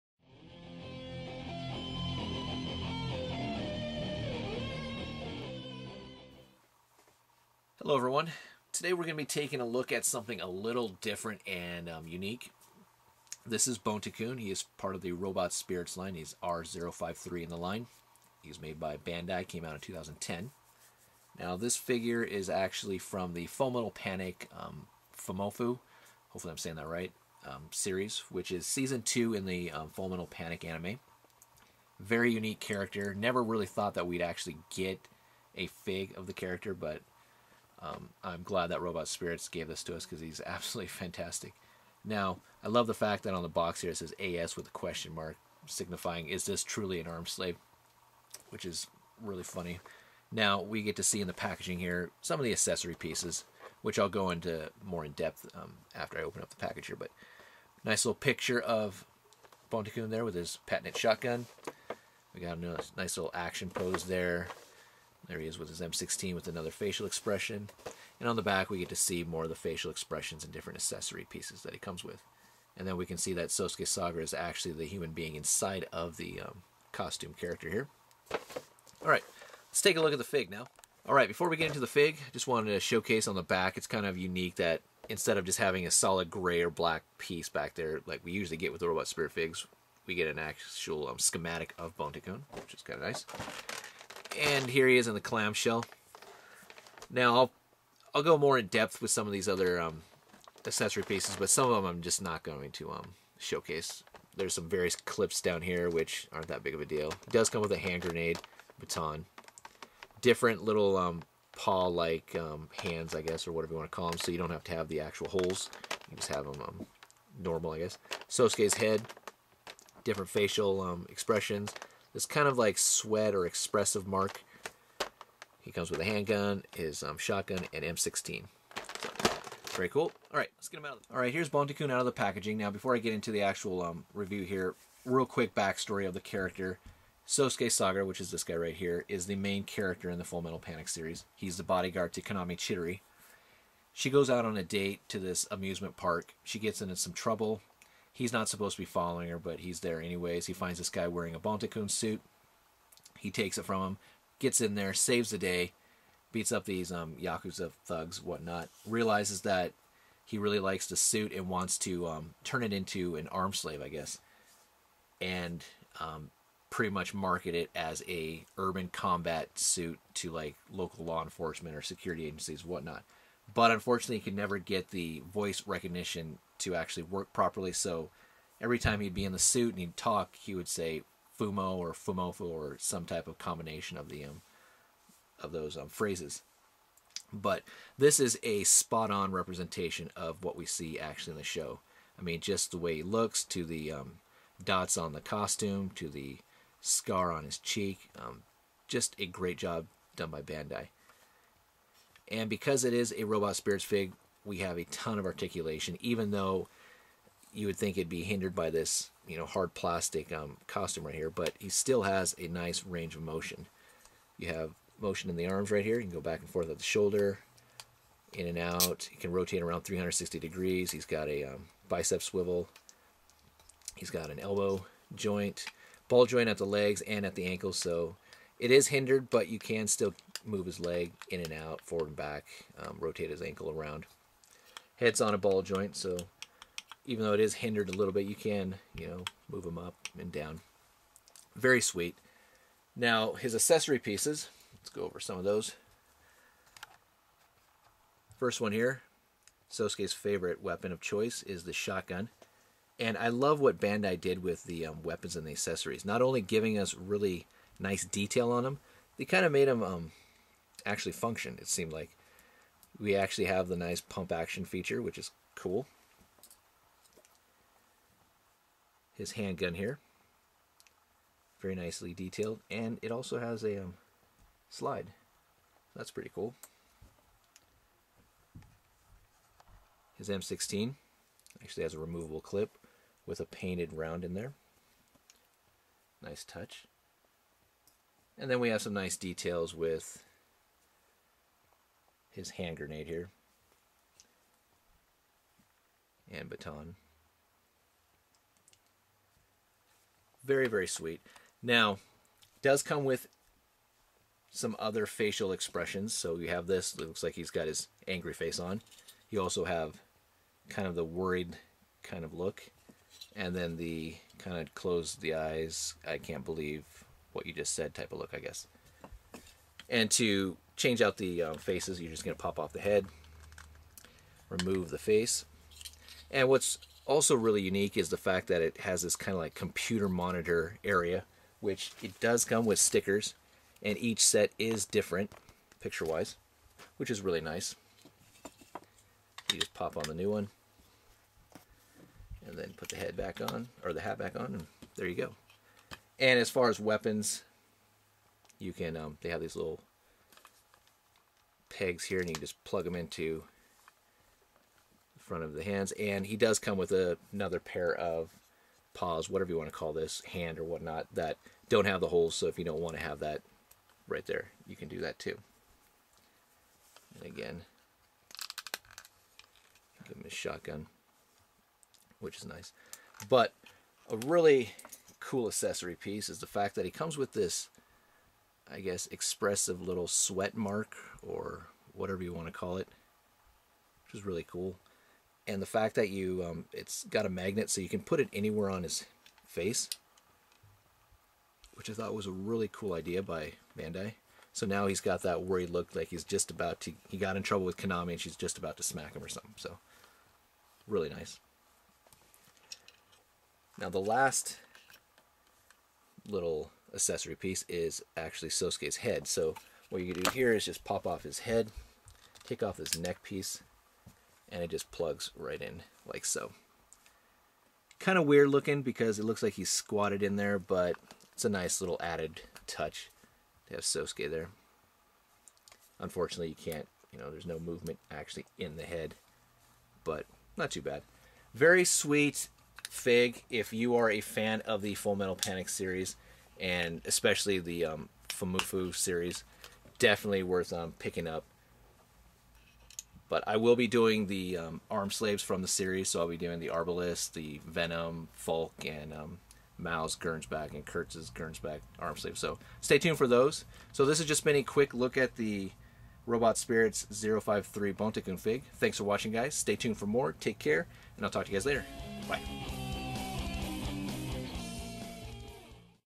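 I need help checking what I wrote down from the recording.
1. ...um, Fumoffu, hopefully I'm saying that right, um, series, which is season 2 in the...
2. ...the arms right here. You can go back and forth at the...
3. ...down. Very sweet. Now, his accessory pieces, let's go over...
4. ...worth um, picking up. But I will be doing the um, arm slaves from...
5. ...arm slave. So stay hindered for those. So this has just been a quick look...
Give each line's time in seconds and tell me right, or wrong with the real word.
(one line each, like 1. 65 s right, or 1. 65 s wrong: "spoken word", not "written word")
1. 24 s right
2. 215 s right
3. 240 s right
4. 440 s right
5. 451 s wrong: "tuned", not "hindered".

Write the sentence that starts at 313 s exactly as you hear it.
And then the kind of close the eyes, I can't believe what you just said type of look, I guess.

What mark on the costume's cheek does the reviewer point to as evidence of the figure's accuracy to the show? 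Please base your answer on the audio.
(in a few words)
Scar.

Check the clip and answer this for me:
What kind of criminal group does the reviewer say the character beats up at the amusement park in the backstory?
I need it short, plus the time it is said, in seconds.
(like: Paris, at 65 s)
Yakuza, at 157 s.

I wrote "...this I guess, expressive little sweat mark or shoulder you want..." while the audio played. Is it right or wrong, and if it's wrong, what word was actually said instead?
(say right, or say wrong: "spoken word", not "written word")
wrong: "whatever", not "shoulder".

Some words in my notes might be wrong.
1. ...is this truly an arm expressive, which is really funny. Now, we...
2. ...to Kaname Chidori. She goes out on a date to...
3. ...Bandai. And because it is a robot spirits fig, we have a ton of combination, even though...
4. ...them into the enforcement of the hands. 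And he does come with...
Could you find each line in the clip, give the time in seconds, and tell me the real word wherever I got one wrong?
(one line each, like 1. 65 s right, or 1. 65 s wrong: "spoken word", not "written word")
1. 46 s wrong: "slave", not "expressive"
2. 142 s right
3. 200 s wrong: "articulation", not "combination"
4. 352 s wrong: "front", not "enforcement".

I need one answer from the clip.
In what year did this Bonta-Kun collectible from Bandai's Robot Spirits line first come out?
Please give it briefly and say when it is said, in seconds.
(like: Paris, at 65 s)
2010, at 19 s.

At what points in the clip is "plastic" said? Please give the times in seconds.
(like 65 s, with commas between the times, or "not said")
209 s.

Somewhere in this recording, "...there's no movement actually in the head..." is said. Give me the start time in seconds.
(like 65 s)
427 s.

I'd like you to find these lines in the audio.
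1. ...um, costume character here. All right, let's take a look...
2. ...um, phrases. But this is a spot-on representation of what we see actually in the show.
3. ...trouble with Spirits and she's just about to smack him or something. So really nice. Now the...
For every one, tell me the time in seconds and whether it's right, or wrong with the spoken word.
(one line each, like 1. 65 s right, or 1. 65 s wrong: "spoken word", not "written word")
1. 76 s right
2. 185 s right
3. 397 s wrong: "Kaname", not "Spirits".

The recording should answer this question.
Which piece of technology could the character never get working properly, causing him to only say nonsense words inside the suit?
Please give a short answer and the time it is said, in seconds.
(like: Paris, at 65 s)
Voice recognition, at 175 s.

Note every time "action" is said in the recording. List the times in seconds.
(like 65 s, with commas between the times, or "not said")
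63 s, 264 s.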